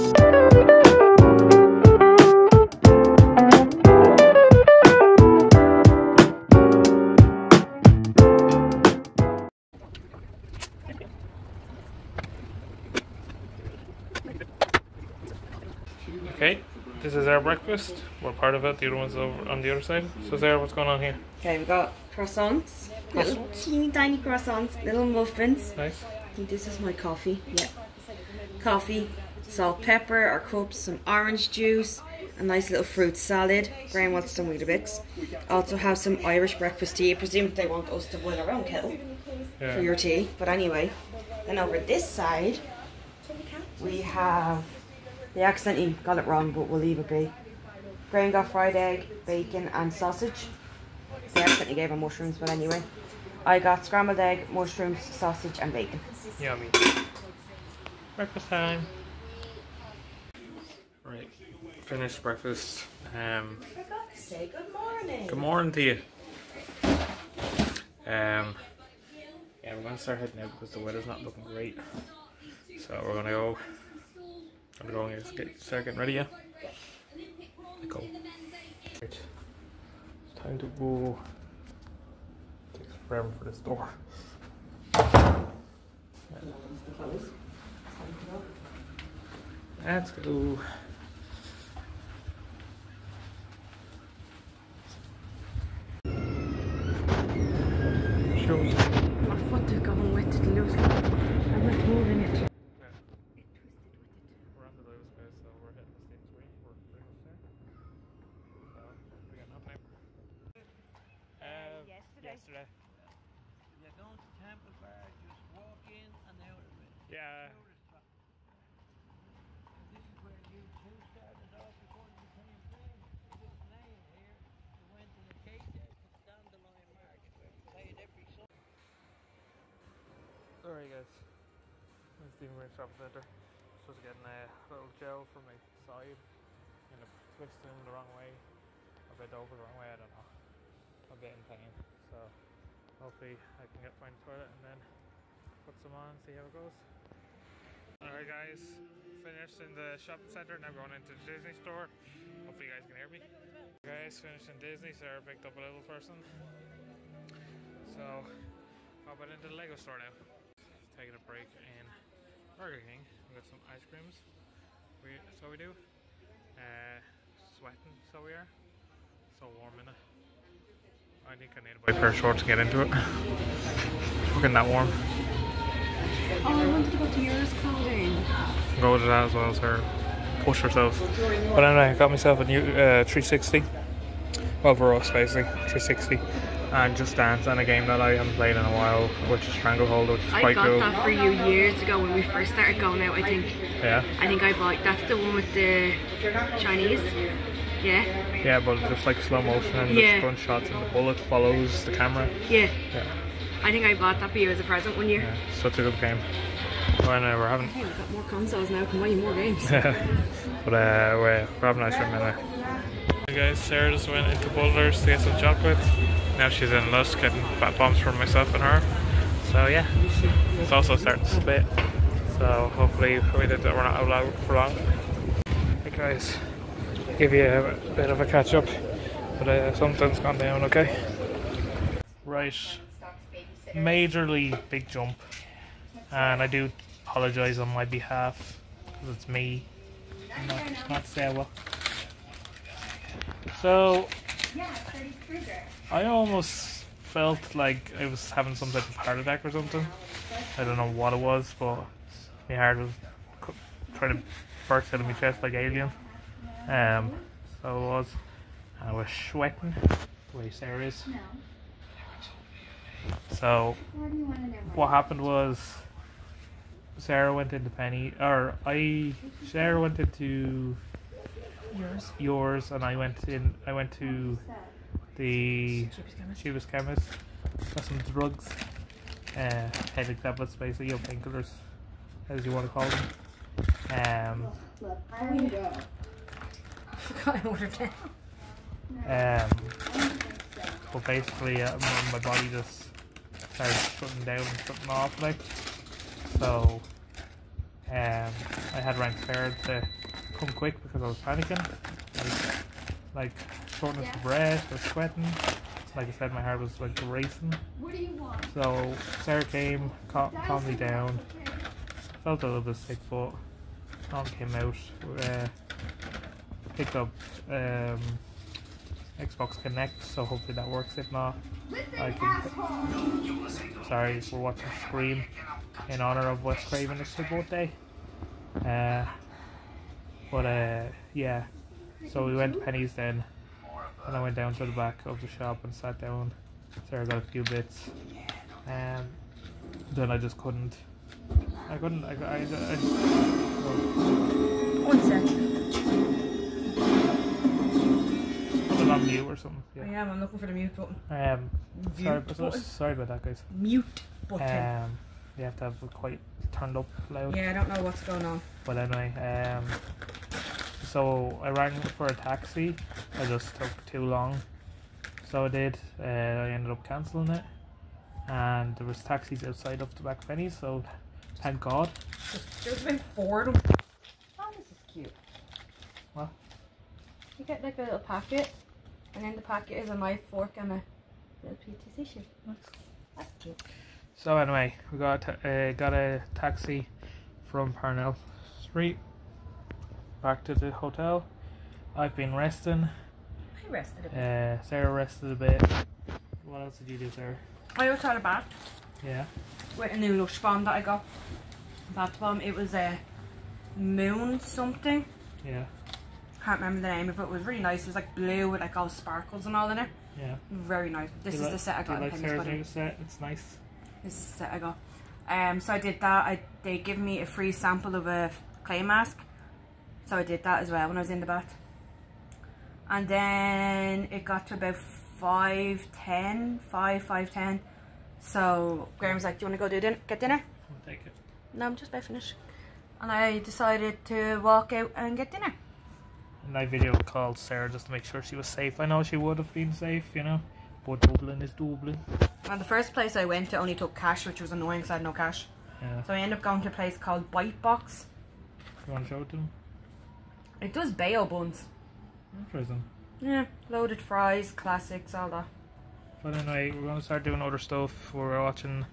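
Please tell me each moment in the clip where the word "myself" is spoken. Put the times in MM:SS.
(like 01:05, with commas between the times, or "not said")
03:02, 03:38.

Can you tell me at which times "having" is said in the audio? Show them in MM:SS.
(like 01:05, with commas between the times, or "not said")
03:27, 03:31, 04:08.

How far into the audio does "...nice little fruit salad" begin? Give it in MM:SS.
00:32.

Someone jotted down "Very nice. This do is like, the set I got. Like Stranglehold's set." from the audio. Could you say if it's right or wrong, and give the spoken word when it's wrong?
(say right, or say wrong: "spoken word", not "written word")
wrong: "Sarah", not "Stranglehold".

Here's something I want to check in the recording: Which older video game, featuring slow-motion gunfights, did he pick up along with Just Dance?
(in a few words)
Stranglehold.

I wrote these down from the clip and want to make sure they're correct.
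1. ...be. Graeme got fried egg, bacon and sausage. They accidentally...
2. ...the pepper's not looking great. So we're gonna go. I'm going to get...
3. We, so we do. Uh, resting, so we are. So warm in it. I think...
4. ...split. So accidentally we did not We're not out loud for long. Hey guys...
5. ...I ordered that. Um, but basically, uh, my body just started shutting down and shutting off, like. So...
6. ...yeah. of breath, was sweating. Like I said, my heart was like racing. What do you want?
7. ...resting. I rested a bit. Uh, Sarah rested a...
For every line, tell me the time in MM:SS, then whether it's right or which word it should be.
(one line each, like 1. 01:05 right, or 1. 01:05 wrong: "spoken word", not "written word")
1. 00:47 right
2. 01:10 wrong: "weather", not "pepper"
3. 02:45 wrong: "sweating", not "resting"
4. 03:41 wrong: "hopefully", not "accidentally"
5. 04:47 right
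6. 05:04 right
7. 06:32 right.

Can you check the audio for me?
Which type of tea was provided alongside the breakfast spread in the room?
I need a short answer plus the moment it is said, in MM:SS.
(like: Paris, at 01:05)
Irish breakfast tea, at 00:36.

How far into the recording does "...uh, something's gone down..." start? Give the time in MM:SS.
03:49.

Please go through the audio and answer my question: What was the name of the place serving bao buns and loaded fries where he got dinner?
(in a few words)
Bite Box.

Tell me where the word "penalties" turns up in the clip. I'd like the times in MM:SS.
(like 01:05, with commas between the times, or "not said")
not said.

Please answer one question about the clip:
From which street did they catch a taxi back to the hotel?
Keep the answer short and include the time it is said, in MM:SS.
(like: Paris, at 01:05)
Parnell Street, at 06:27.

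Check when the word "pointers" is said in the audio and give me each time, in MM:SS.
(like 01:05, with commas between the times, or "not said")
not said.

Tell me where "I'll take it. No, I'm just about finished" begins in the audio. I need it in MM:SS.
07:10.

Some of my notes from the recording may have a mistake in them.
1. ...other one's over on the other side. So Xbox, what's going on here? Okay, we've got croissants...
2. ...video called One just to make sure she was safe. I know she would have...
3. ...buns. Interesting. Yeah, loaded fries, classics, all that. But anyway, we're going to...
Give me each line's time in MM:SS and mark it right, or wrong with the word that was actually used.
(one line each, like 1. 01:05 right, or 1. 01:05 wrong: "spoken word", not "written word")
1. 00:18 wrong: "Sarah", not "Xbox"
2. 07:16 wrong: "Sarah", not "One"
3. 07:31 right.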